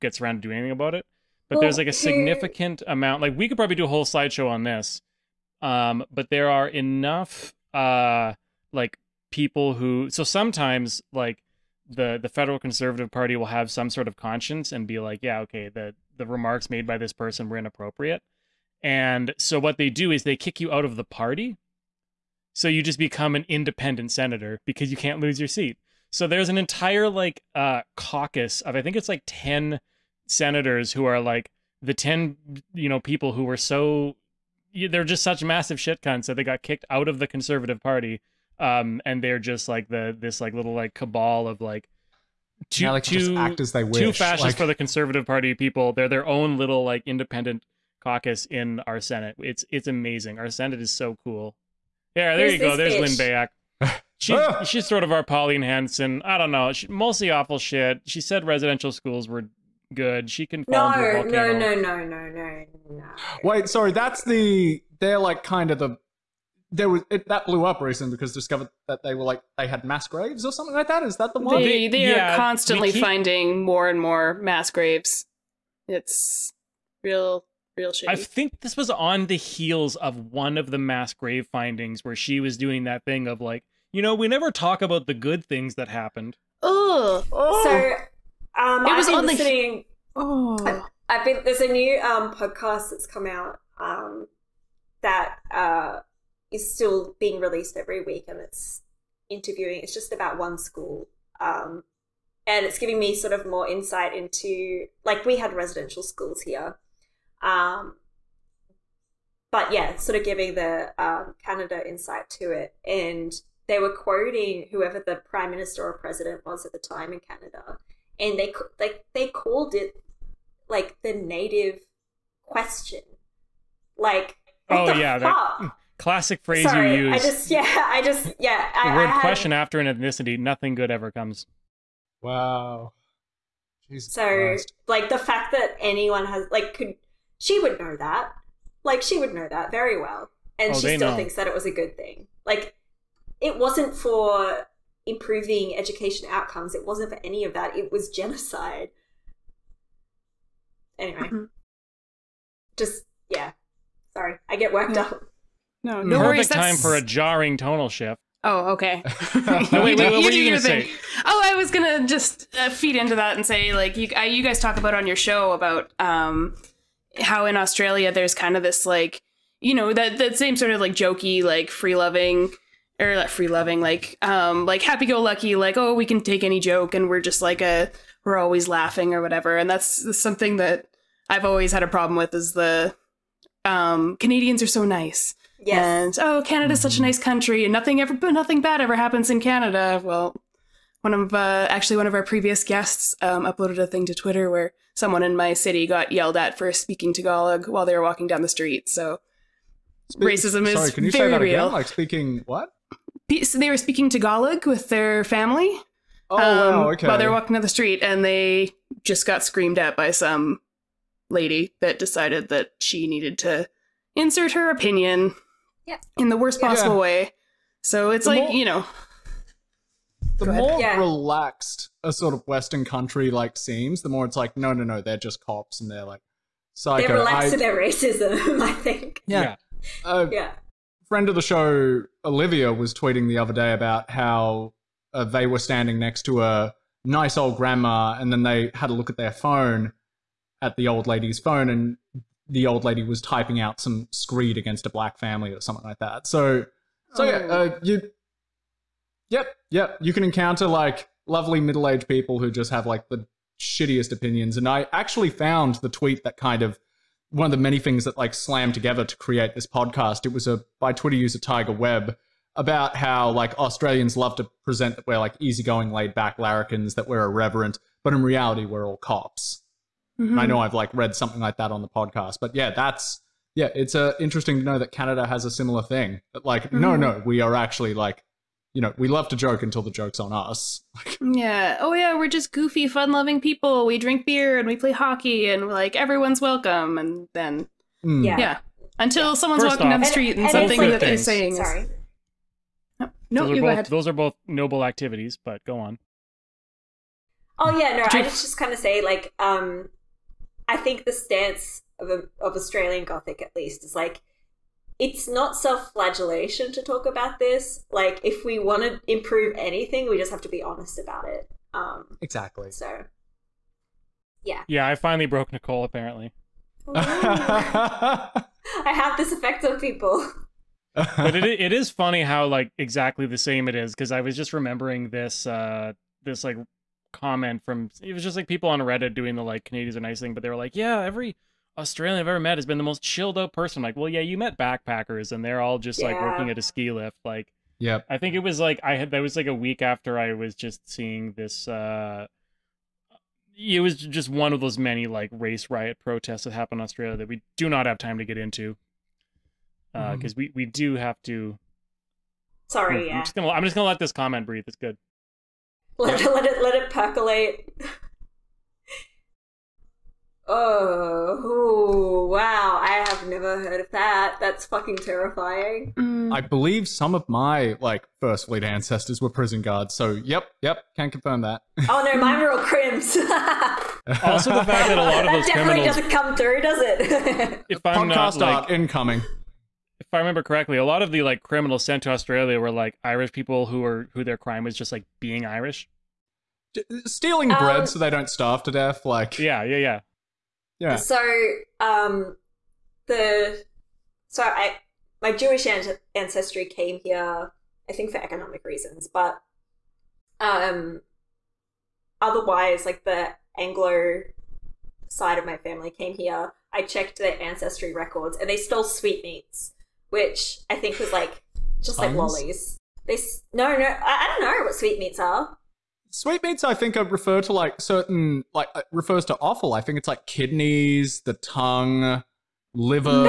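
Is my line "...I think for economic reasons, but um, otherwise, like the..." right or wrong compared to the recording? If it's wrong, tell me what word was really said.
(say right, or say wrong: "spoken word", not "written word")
right.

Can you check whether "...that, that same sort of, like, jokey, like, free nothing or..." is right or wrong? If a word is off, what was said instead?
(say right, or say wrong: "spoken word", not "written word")
wrong: "loving", not "nothing".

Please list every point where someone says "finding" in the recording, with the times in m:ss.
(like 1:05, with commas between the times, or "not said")
1:13, 1:21.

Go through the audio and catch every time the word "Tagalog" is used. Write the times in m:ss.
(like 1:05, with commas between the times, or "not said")
3:17, 3:24.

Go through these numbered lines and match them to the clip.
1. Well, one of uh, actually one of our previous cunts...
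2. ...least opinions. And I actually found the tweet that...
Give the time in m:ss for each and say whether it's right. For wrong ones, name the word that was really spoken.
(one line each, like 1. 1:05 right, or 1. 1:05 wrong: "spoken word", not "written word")
1. 3:10 wrong: "guests", not "cunts"
2. 4:13 wrong: "shittiest", not "least".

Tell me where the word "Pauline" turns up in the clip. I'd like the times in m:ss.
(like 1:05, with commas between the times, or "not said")
0:55.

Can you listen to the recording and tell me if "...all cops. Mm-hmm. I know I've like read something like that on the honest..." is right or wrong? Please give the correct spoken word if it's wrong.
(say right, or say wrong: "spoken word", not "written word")
wrong: "podcast", not "honest".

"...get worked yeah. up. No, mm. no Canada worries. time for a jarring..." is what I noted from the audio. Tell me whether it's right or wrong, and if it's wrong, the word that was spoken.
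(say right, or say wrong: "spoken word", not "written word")
wrong: "Perfect", not "Canada".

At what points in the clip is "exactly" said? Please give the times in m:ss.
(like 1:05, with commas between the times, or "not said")
5:12, 5:22.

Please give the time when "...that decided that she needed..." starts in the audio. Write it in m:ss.
3:31.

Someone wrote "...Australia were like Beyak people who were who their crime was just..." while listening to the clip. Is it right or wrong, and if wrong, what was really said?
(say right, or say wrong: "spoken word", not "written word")
wrong: "Irish", not "Beyak".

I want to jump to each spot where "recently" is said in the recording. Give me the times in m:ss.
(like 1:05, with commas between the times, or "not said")
1:07.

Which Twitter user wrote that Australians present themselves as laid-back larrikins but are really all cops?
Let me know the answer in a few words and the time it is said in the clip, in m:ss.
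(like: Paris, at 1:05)
Tiger Webb, at 4:21.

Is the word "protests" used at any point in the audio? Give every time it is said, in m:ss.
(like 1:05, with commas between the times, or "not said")
5:45.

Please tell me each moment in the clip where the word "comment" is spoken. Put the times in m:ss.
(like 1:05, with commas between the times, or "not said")
5:27, 5:54.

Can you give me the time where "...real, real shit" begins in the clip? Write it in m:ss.
1:17.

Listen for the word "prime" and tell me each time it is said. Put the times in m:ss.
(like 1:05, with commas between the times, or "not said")
1:55.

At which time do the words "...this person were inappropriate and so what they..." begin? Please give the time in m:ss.
0:16.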